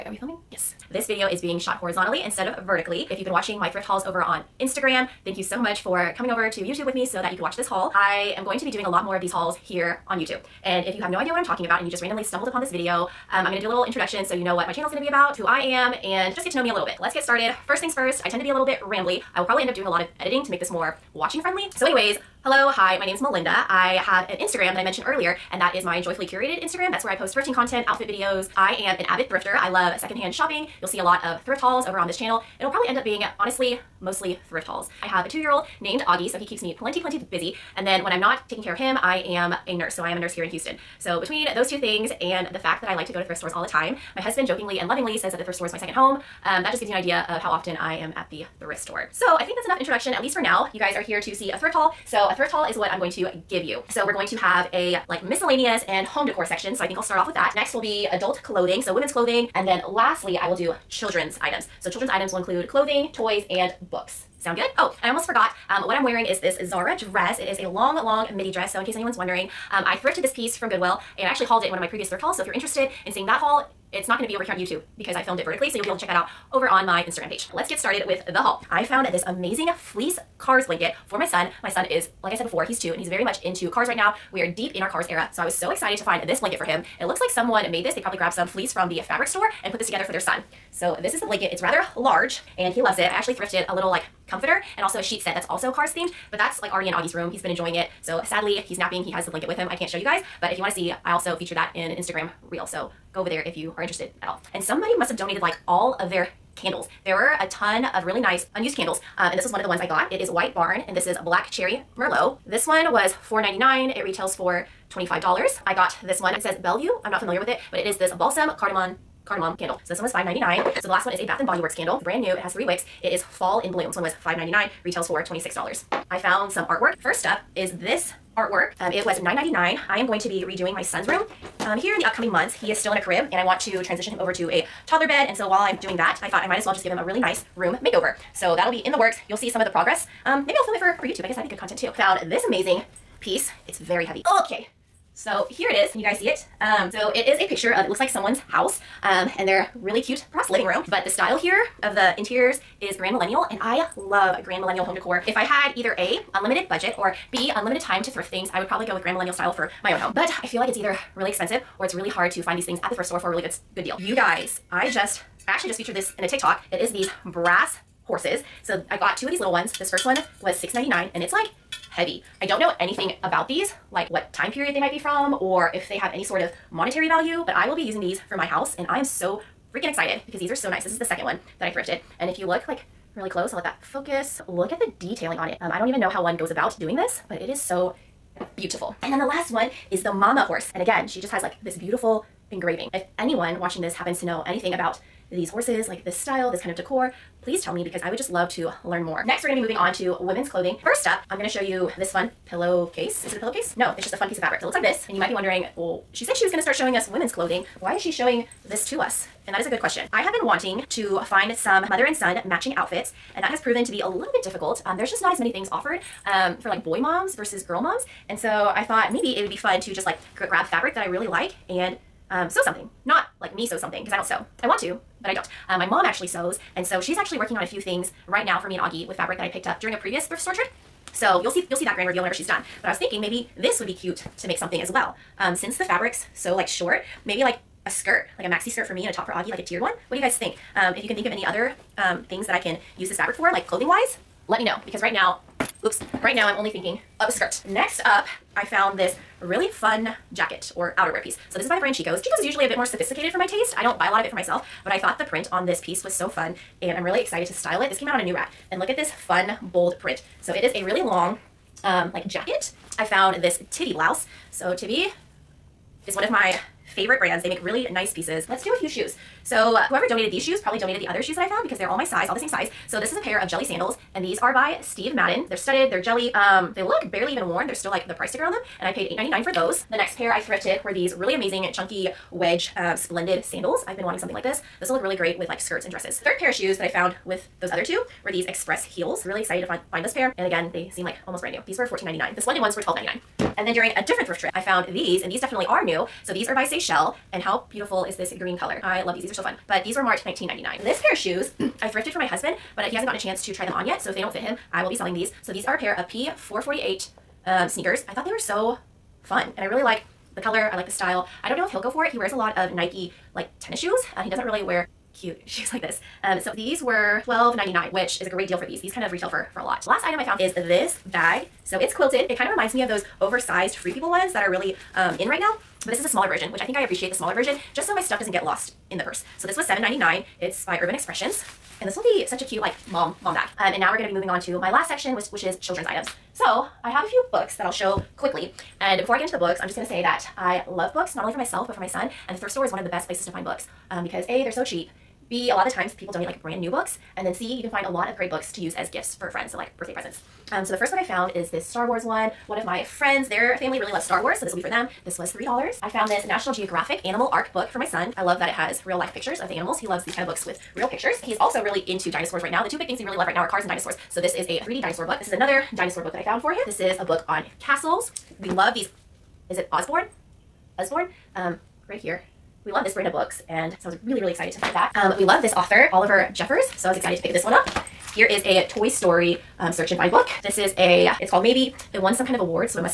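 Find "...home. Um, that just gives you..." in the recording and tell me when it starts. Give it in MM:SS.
00:45.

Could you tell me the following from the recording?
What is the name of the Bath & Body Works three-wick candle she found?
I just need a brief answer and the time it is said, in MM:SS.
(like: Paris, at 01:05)
Fall in Bloom, at 02:03.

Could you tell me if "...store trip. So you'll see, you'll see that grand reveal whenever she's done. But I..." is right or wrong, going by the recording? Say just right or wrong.
right.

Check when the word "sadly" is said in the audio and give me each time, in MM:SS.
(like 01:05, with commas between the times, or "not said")
01:38.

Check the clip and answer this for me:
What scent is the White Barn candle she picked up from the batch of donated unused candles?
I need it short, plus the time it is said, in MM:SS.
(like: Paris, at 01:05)
Black Cherry Merlot, at 01:51.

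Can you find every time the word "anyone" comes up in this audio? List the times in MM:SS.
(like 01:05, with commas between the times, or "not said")
01:08, 03:13.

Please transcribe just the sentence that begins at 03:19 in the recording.
Next, we're gonna be moving on to women's clothing.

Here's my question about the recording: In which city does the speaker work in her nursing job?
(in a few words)
Houston.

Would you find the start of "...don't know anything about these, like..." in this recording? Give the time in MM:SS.
02:52.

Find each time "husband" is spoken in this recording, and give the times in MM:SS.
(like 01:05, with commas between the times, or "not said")
00:44, 05:02.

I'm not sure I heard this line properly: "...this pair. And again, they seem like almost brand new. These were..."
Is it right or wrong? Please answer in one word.
right.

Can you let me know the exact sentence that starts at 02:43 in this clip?
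You guys, I just, I actually just featured this in a TikTok.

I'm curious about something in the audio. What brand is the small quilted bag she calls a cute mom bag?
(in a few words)
Urban Expressions.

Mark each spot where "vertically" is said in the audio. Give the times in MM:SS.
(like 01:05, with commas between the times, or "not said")
00:02, 01:15.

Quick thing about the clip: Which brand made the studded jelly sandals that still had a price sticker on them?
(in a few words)
Steve Madden.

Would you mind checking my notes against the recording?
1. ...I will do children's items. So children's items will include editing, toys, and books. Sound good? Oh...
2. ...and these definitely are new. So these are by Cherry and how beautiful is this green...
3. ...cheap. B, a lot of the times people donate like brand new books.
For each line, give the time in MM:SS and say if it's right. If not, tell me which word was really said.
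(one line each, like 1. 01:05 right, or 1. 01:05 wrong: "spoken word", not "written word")
1. 01:00 wrong: "clothing", not "editing"
2. 04:55 wrong: "Seychelles", not "Cherry"
3. 05:44 right.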